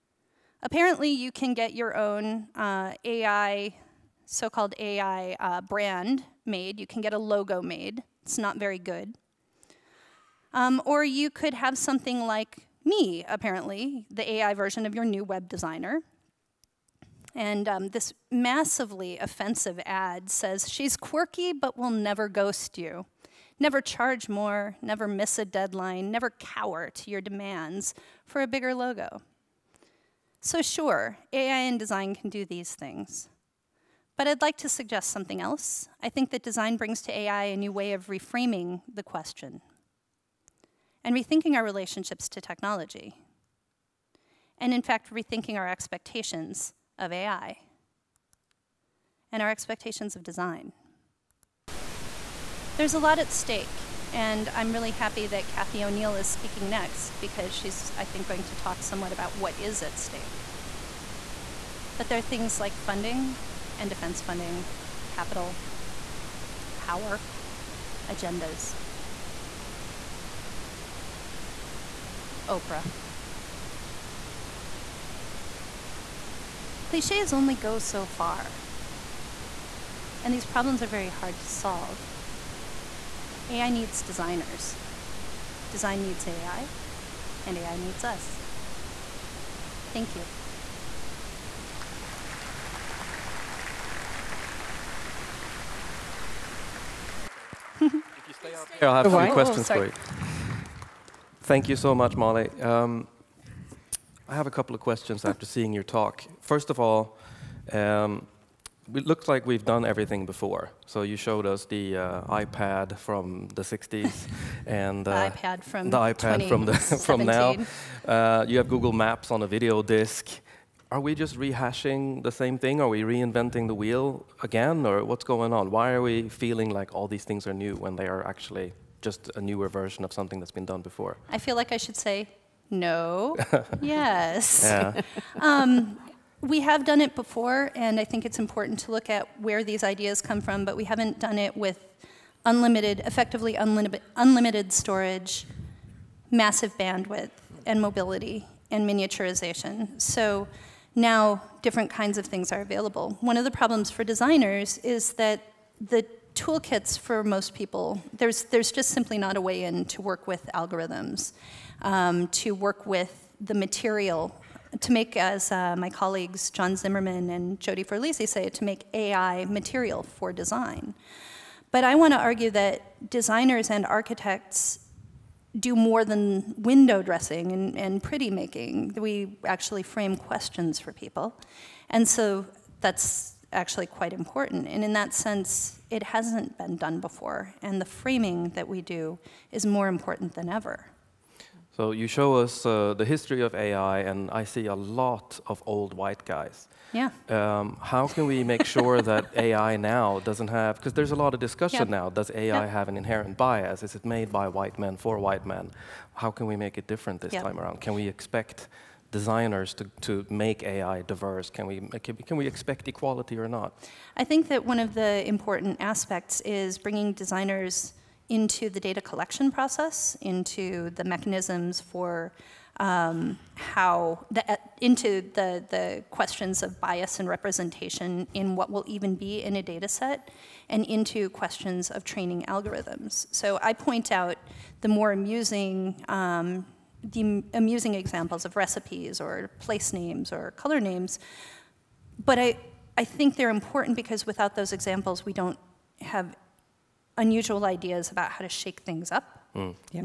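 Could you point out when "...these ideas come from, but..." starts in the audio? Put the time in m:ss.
2:19.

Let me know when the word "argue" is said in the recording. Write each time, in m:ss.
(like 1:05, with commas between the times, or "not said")
2:52.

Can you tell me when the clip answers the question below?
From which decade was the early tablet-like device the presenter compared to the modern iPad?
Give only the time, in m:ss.
1:53.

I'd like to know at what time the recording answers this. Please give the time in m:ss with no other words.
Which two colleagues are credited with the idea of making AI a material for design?
2:46.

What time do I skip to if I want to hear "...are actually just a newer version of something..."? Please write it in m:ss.
2:08.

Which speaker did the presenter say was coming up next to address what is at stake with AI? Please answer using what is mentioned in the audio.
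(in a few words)
Cathy O'Neil.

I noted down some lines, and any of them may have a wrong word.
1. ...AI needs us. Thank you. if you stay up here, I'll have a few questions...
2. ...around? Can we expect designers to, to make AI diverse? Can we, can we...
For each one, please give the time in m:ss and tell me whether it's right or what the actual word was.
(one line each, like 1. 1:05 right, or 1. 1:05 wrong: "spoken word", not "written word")
1. 1:27 right
2. 3:27 right.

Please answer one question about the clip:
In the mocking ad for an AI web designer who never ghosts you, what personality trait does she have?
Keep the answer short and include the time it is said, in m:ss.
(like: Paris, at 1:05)
Quirky, at 0:20.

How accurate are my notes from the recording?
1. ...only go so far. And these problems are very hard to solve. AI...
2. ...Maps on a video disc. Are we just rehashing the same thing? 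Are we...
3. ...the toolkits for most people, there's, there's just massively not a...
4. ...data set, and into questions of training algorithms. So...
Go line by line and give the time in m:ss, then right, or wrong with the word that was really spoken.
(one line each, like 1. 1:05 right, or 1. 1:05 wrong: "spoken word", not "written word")
1. 1:17 right
2. 1:58 right
3. 2:35 wrong: "simply", not "massively"
4. 3:49 right.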